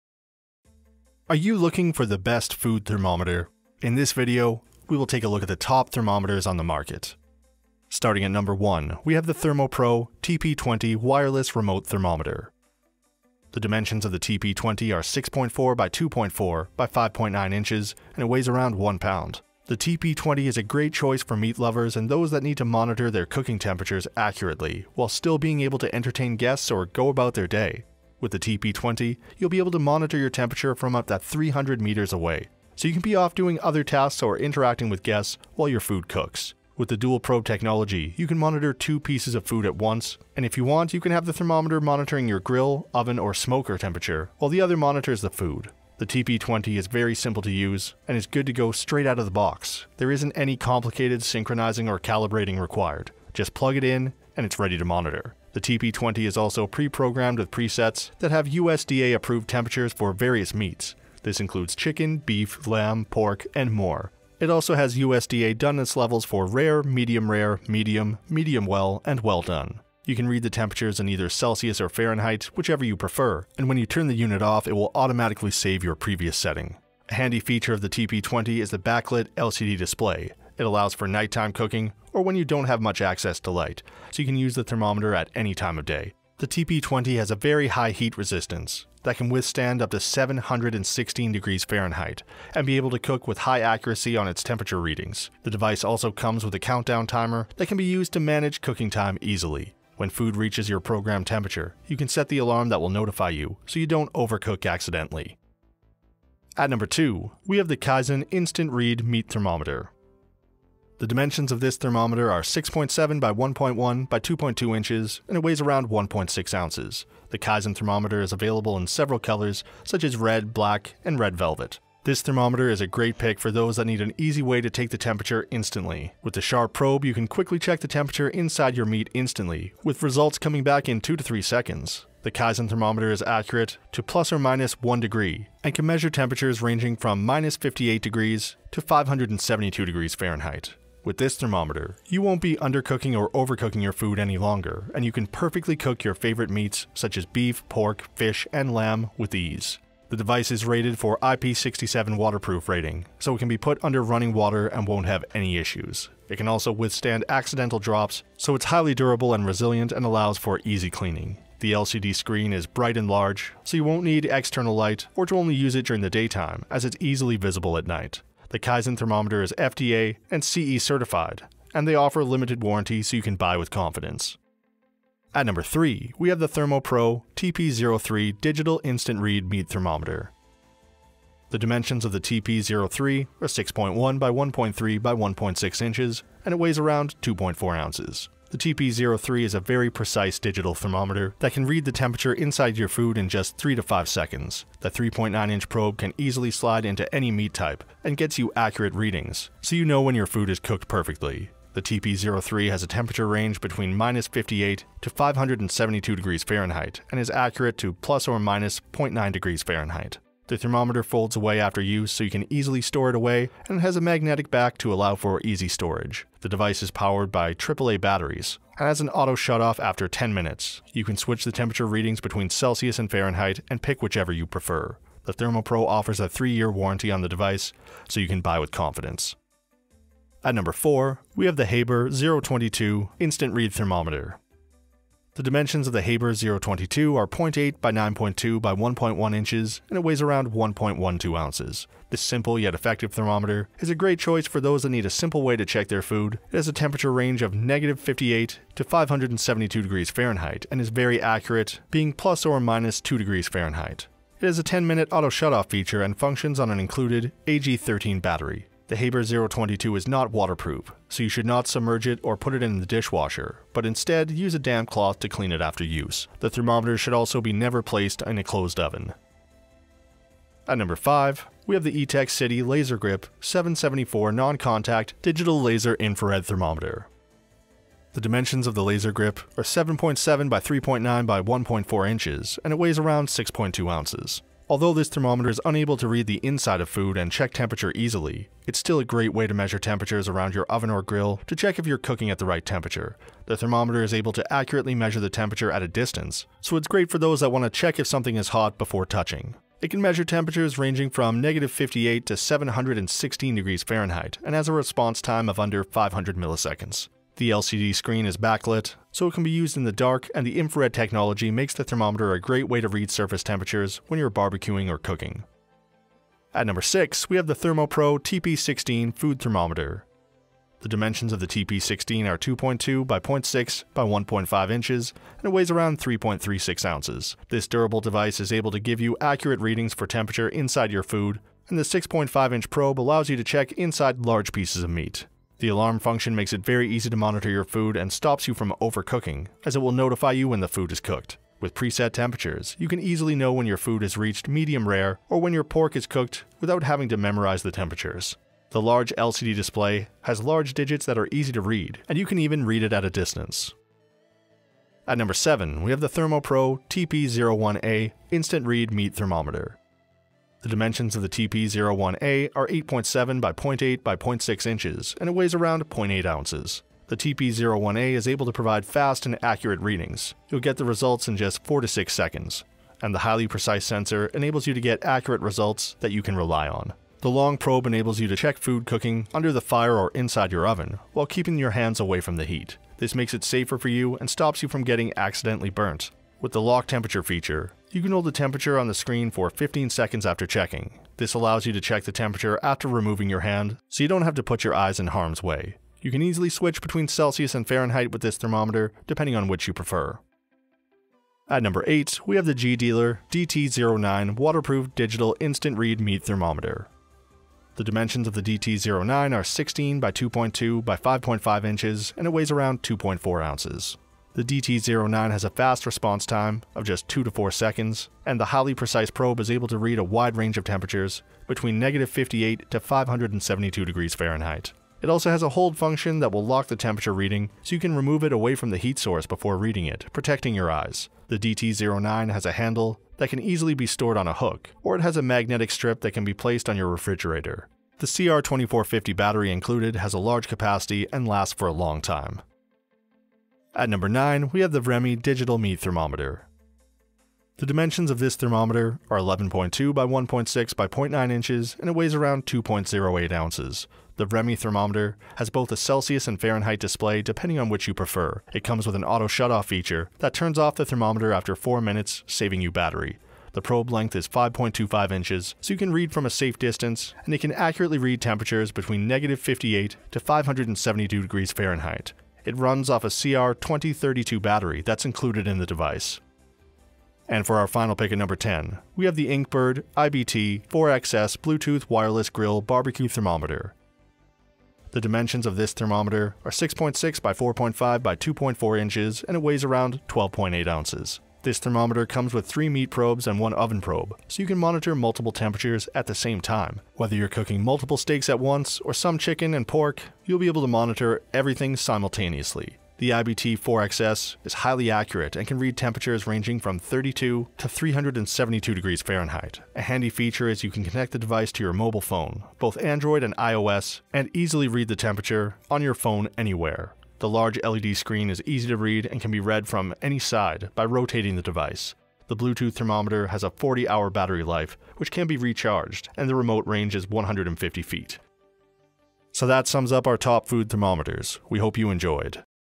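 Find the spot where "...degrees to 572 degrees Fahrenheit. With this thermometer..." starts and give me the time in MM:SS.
02:18.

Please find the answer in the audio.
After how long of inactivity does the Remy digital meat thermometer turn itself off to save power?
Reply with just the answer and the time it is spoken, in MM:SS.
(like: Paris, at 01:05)
4 minutes, at 07:41.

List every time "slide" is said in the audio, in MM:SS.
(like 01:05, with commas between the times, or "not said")
03:16.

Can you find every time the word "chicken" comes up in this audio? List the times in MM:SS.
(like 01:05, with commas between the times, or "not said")
01:01, 08:19.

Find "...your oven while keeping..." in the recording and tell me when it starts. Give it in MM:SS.
06:20.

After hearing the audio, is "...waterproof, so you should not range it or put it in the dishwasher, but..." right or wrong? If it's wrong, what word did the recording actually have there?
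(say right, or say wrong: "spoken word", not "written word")
wrong: "submerge", not "range".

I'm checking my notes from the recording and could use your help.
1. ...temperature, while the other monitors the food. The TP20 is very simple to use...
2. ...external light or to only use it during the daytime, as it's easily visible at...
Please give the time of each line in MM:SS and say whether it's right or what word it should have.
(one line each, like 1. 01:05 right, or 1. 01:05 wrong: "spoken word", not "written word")
1. 00:43 right
2. 02:44 right.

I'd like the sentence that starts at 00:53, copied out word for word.
Just plug it in, and it's ready to monitor.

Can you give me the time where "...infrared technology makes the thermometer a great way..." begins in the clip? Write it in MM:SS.
05:10.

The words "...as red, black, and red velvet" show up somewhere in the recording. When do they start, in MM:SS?
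02:00.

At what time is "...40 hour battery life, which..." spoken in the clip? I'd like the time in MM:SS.
08:43.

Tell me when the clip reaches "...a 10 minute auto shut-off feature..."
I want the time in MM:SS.
04:14.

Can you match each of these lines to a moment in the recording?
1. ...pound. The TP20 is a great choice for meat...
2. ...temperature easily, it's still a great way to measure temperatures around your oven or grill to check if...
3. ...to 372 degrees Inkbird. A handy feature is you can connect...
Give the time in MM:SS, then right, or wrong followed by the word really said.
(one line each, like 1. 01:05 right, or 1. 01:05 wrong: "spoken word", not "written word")
1. 00:18 right
2. 04:47 right
3. 08:27 wrong: "Fahrenheit", not "Inkbird".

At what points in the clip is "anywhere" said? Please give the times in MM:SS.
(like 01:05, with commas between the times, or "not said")
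08:36.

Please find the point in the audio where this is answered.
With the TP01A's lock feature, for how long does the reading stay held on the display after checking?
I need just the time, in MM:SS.
06:29.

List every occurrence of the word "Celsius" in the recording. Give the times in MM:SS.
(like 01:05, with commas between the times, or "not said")
01:11, 03:42, 06:37, 07:35.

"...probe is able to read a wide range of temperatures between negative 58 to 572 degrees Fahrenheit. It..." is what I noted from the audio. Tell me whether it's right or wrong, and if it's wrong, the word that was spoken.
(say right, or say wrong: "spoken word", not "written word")
right.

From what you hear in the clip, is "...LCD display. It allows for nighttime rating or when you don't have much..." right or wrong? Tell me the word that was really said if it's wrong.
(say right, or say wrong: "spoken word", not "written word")
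wrong: "cooking", not "rating".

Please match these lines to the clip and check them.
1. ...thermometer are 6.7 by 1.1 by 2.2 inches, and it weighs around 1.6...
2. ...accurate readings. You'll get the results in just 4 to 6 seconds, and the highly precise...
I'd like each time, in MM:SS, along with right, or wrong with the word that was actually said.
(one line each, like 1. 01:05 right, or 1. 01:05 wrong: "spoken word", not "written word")
1. 01:51 right
2. 06:09 right.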